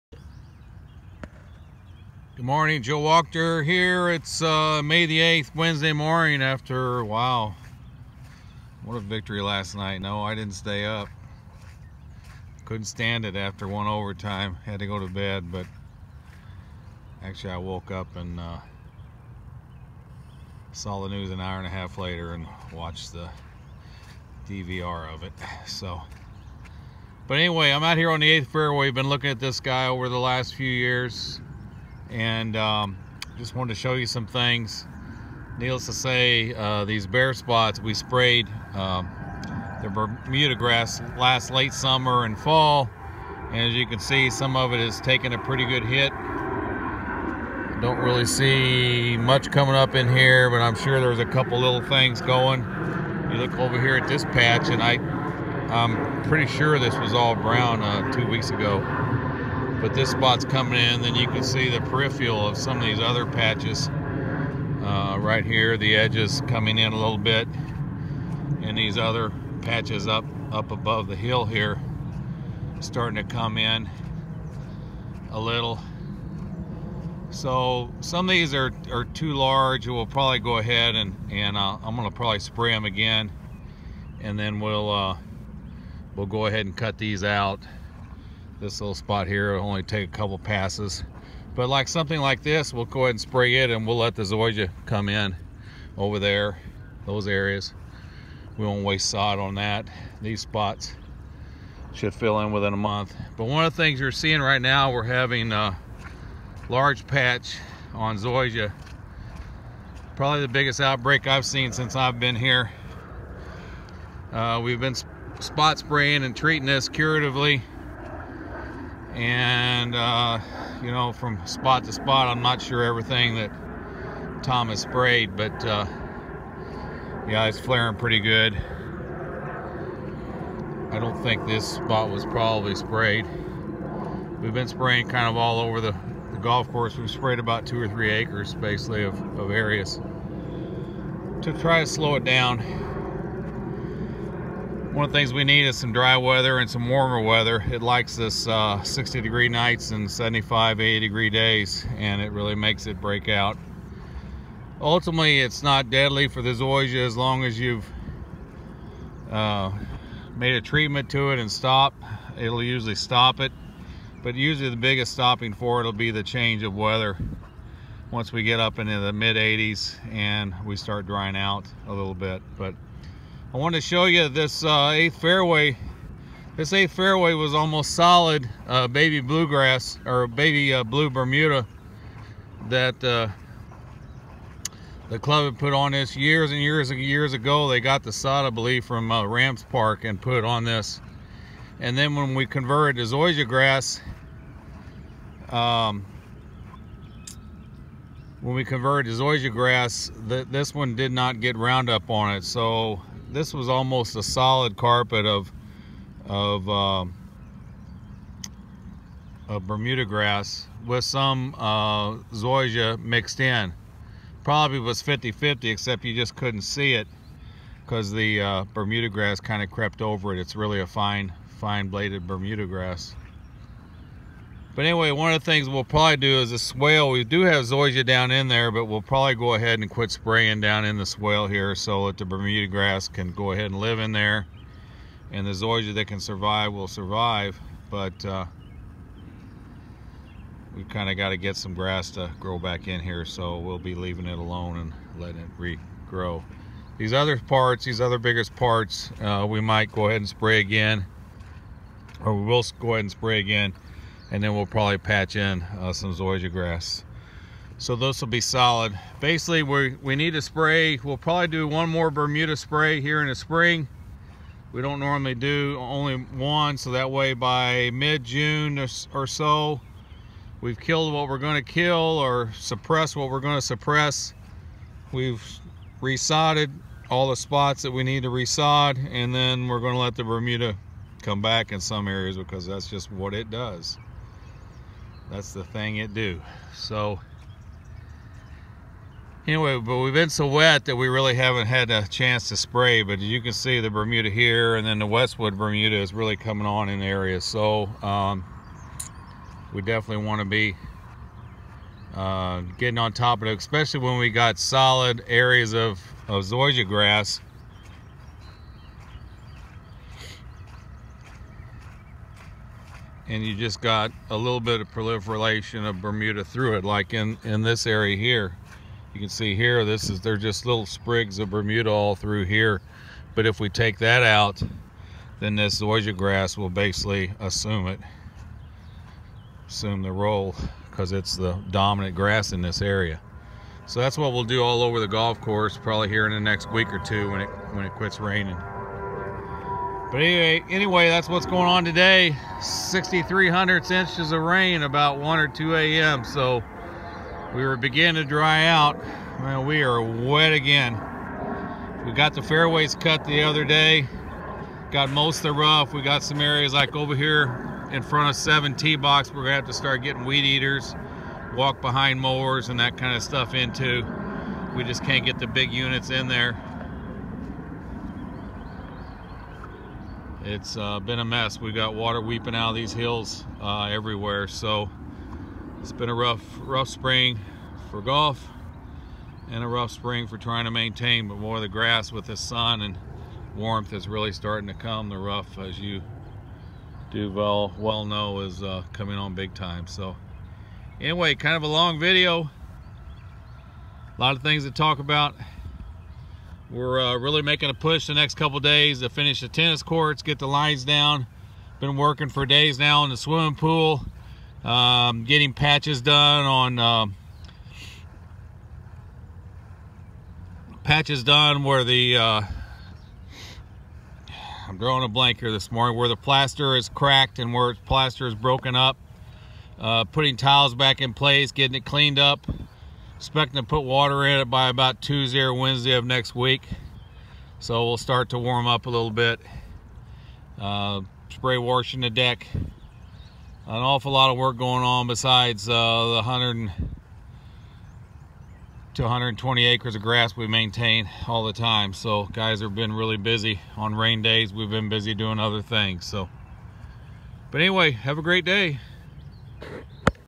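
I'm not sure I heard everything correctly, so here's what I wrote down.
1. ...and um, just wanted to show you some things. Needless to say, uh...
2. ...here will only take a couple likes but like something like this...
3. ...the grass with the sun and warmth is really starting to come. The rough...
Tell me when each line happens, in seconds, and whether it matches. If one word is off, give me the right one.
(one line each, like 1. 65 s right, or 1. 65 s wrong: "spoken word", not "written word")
1. 32 s right
2. 89 s wrong: "passes", not "likes"
3. 381 s right.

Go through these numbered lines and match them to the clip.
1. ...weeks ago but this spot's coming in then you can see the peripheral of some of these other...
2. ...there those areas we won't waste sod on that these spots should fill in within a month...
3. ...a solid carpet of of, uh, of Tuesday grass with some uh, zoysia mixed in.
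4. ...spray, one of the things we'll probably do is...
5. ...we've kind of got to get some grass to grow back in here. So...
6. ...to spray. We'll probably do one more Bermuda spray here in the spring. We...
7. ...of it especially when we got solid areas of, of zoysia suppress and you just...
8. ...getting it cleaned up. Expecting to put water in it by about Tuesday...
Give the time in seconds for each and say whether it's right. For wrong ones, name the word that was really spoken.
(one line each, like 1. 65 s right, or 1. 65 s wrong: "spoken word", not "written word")
1. 58 s right
2. 96 s right
3. 204 s wrong: "Bermuda", not "Tuesday"
4. 224 s wrong: "anyway", not "spray"
5. 240 s right
6. 260 s right
7. 303 s wrong: "grass", not "suppress"
8. 421 s right.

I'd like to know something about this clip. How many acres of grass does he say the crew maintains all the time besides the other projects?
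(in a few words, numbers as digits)
100 to 120.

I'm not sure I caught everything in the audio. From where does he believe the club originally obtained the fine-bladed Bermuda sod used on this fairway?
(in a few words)
Rams Park.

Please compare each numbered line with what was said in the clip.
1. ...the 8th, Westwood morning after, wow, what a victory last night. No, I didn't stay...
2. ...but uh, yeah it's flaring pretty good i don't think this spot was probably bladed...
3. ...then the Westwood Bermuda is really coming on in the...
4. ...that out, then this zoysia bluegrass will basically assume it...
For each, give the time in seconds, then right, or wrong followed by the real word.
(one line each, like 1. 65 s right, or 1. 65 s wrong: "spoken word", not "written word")
1. 5 s wrong: "Wednesday", not "Westwood"
2. 125 s wrong: "sprayed", not "bladed"
3. 294 s right
4. 323 s wrong: "grass", not "bluegrass".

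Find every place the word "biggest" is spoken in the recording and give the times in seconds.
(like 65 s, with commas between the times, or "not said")
110 s, 164 s, 248 s.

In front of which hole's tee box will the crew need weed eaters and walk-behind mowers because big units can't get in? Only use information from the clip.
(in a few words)
7.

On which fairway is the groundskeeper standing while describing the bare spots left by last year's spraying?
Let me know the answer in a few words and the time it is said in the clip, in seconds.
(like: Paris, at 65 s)
8th, at 28 s.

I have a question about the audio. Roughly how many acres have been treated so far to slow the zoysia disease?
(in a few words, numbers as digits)
2 or 3 acres.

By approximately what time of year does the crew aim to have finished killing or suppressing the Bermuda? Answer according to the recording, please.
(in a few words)
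mid-June.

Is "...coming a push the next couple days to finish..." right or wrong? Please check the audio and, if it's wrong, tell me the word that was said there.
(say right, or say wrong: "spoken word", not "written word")
wrong: "making", not "coming".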